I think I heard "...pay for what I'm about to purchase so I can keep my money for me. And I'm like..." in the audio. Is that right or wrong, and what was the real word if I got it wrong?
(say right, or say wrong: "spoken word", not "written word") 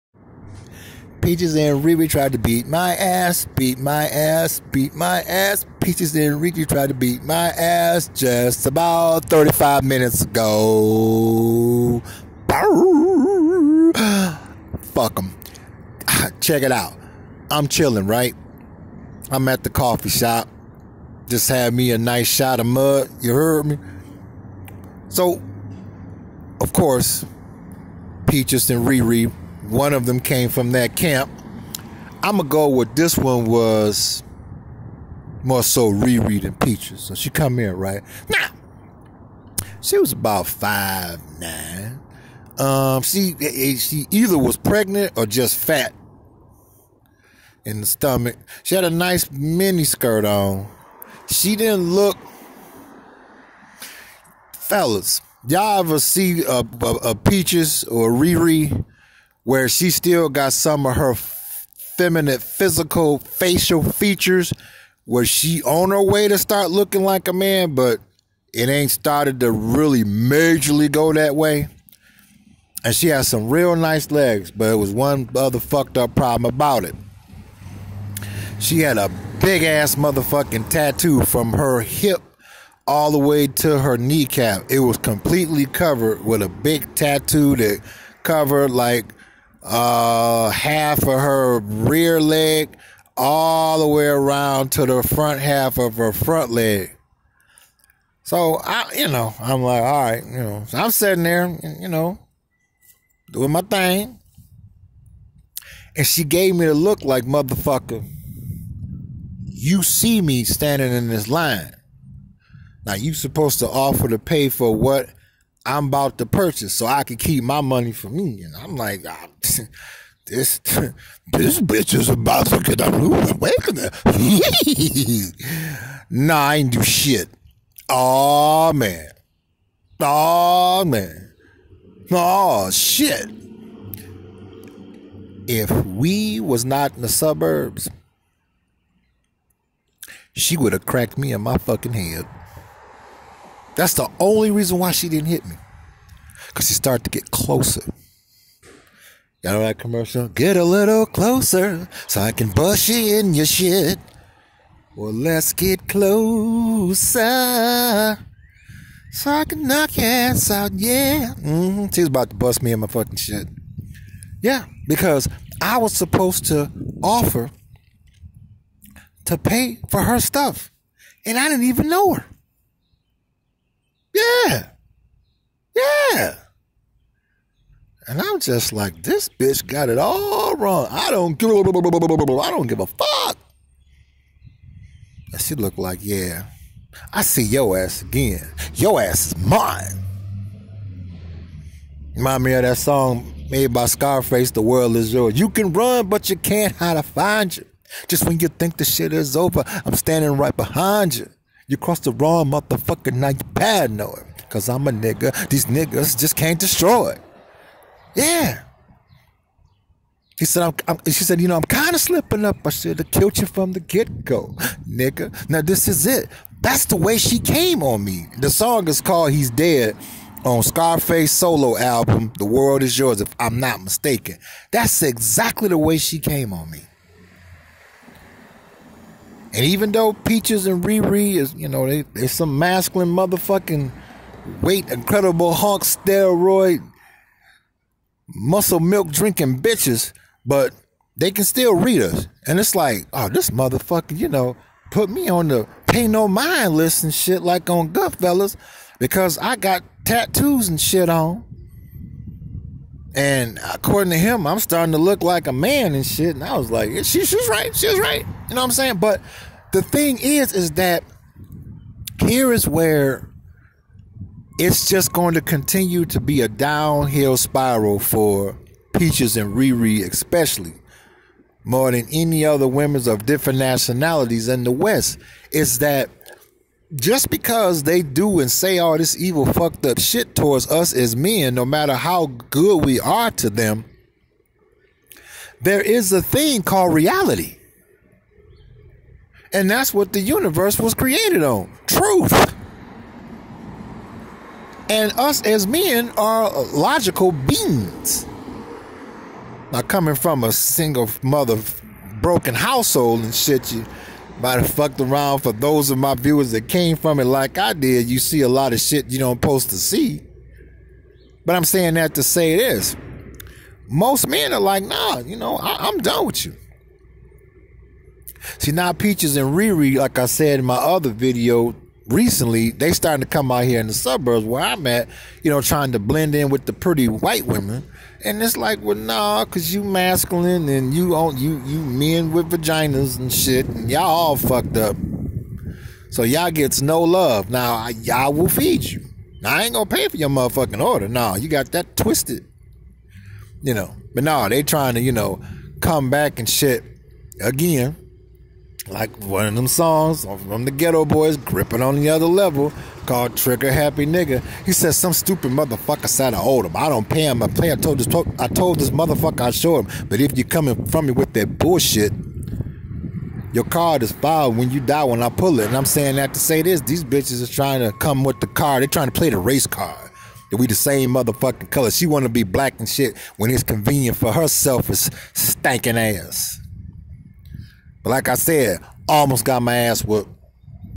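right.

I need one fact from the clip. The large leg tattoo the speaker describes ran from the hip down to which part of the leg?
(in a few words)
Kneecap.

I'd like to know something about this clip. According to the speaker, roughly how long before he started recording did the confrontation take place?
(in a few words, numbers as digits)
35 minutes.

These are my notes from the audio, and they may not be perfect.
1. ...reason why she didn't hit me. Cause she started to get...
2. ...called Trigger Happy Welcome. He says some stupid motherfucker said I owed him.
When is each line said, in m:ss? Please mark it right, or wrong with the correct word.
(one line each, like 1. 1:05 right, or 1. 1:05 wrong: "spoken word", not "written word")
1. 2:24 right
2. 5:53 wrong: "Nigga", not "Welcome".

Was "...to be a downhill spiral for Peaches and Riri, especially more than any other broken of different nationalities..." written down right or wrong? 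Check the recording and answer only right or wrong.
wrong.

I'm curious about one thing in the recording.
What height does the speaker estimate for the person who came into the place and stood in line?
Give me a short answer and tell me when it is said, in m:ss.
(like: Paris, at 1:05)
5'9", at 0:40.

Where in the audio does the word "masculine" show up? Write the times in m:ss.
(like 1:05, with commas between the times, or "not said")
3:52, 5:29.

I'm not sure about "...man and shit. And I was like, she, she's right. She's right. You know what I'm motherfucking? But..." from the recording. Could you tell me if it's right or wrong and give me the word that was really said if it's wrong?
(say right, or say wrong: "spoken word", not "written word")
wrong: "saying", not "motherfucking".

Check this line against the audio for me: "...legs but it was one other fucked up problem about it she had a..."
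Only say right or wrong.
right.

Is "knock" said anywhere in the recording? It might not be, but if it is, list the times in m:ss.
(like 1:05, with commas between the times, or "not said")
2:39.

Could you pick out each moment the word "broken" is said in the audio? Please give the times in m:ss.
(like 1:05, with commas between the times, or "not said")
5:02.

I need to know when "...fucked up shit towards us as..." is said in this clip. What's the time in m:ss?
4:39.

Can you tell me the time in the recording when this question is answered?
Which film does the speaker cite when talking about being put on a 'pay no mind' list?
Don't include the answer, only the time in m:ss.
4:07.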